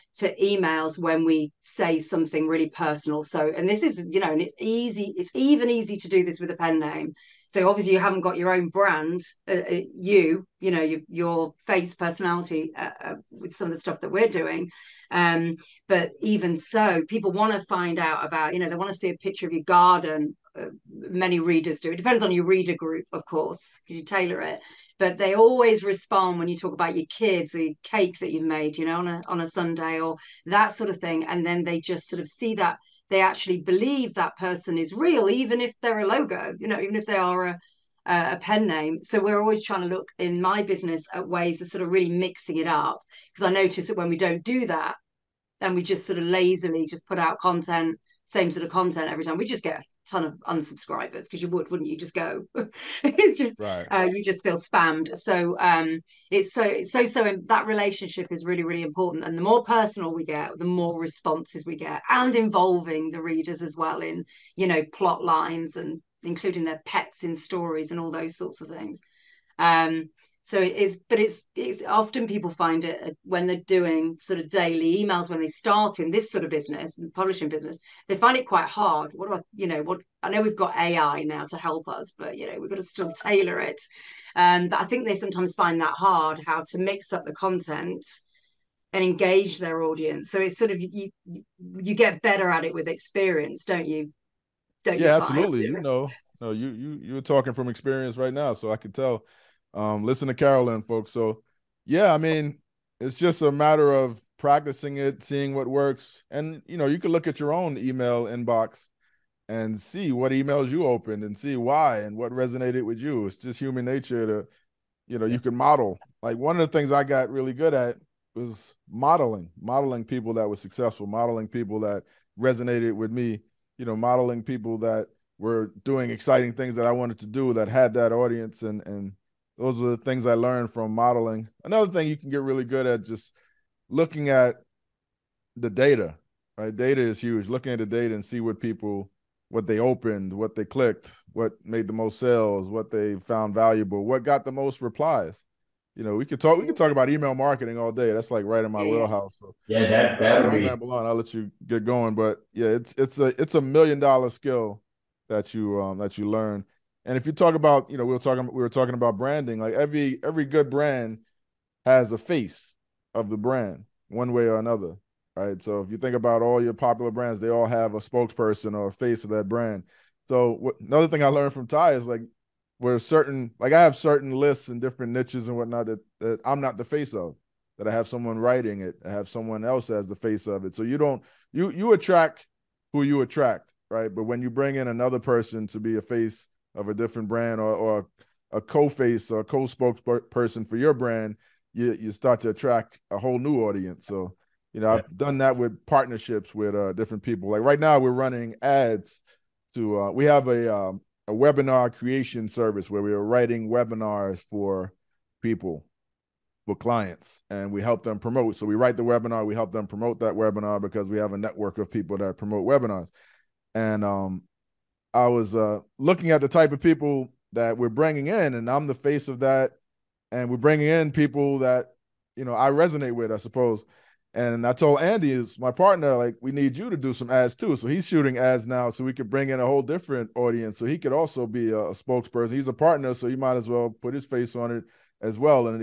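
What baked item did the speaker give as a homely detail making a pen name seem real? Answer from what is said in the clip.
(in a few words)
cake.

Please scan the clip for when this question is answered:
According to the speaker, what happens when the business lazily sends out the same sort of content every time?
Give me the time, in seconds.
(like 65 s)
49 s.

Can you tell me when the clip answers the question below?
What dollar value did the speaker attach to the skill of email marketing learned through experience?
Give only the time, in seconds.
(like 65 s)
153 s.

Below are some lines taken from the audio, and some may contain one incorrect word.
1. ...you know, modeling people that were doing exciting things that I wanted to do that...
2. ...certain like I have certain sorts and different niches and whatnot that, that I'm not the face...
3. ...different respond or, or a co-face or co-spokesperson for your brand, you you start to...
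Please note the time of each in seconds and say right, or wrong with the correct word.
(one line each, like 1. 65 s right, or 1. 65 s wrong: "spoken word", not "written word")
1. 123 s right
2. 172 s wrong: "lists", not "sorts"
3. 186 s wrong: "brand", not "respond".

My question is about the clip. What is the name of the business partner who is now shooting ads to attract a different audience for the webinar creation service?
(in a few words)
Andy.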